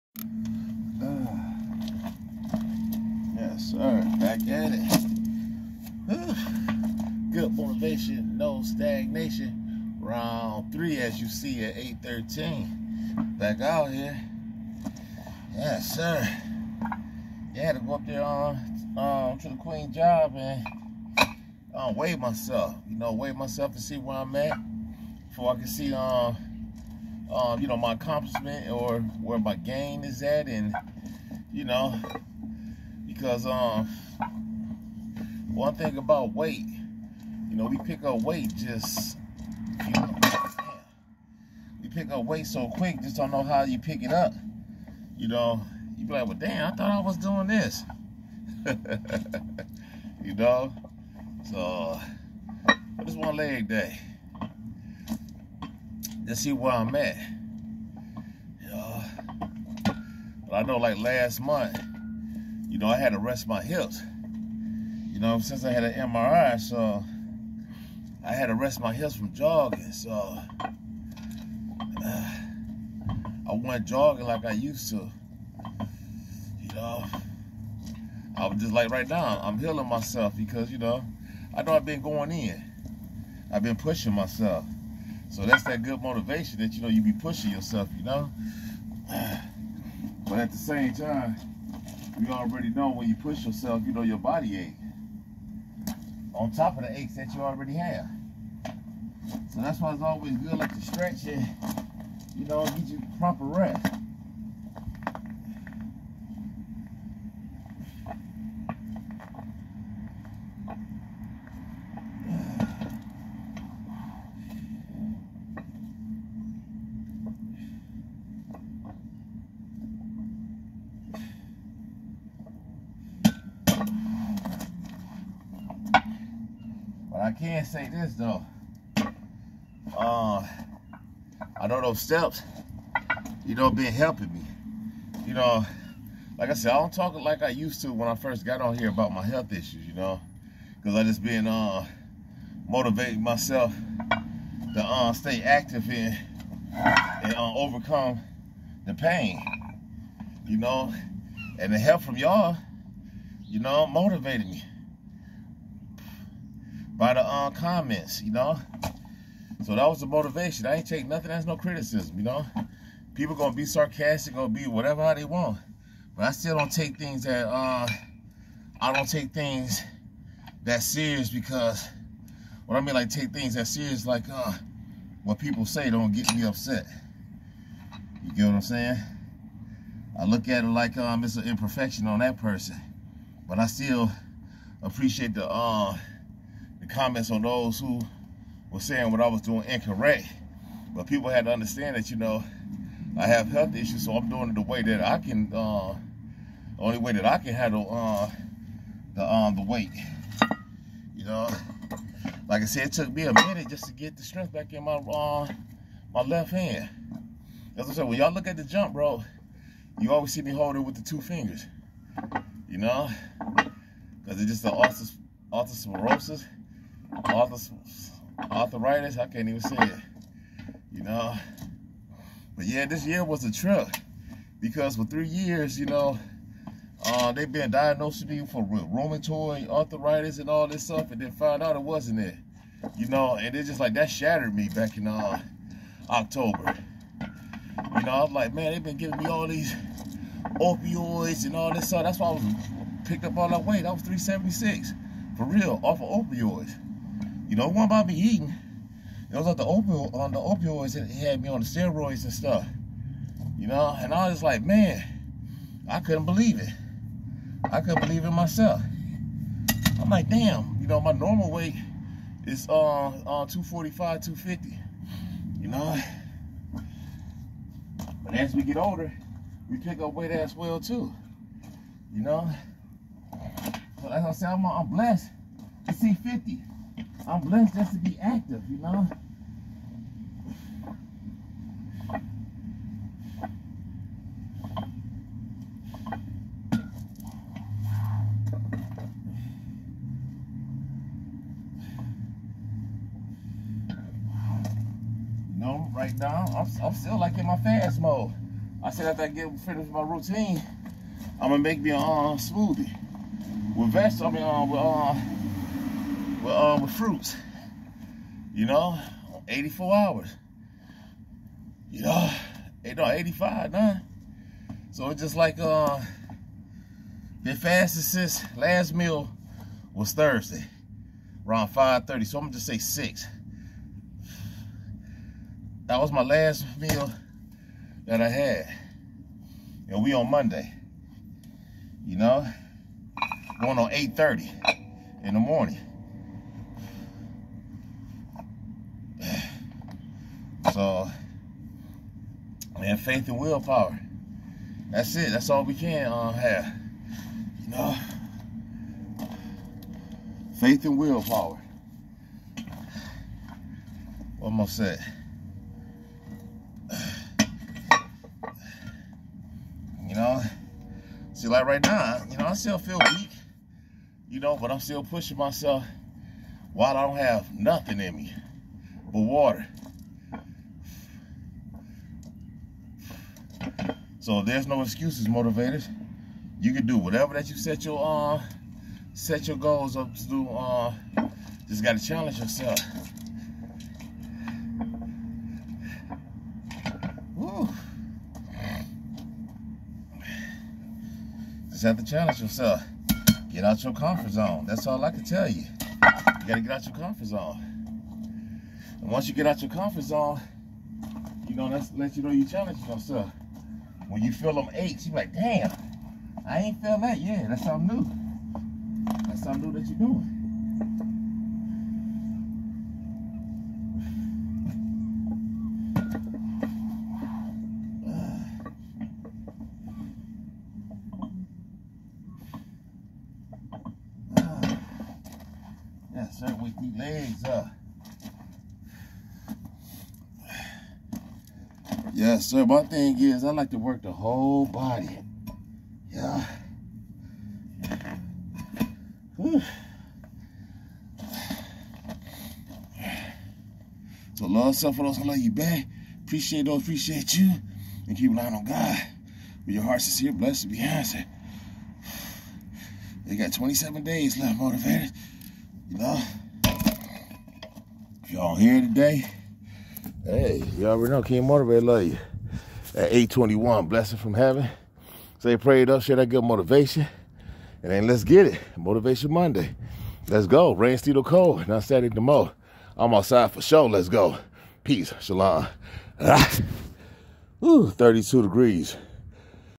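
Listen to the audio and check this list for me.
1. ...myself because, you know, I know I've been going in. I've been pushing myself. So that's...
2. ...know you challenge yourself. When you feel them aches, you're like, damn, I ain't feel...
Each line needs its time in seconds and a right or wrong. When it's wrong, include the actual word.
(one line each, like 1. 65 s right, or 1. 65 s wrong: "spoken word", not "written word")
1. 79 s right
2. 402 s right.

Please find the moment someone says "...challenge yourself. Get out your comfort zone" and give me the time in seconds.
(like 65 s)
392 s.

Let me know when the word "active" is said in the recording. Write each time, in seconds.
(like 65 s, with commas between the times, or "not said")
145 s, 278 s.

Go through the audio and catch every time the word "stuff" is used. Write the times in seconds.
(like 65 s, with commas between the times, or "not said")
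230 s, 241 s, 252 s.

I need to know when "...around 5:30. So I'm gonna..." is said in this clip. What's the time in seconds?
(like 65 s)
321 s.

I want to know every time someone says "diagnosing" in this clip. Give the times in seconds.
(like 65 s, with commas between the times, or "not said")
227 s.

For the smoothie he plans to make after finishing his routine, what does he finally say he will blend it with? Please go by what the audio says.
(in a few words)
fruits.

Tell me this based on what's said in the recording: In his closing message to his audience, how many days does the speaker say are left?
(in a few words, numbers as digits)
27.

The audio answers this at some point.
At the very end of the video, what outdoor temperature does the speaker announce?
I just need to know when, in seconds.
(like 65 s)
477 s.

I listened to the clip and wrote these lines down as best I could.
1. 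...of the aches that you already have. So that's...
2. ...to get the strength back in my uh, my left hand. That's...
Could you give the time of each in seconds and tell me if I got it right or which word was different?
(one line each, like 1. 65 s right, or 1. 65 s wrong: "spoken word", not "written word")
1. 96 s right
2. 203 s right.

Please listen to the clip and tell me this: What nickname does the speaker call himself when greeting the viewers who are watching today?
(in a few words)
King Motivator.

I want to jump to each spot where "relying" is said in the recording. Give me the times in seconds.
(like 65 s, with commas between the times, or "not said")
448 s.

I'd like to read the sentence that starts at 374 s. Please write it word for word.
So there's no excuses, motivators, you can do whatever that you set your uh set your goals up to do.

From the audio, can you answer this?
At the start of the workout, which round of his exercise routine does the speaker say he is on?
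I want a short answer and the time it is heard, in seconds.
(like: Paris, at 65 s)
Round three, at 10 s.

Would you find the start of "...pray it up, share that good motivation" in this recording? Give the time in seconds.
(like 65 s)
465 s.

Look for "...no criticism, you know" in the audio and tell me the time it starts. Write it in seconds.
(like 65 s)
161 s.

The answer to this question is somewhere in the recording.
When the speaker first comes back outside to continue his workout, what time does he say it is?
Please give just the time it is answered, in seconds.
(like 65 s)
11 s.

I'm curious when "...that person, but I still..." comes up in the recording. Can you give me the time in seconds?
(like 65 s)
182 s.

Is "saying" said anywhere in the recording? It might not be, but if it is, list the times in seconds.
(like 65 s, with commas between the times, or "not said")
178 s, 188 s.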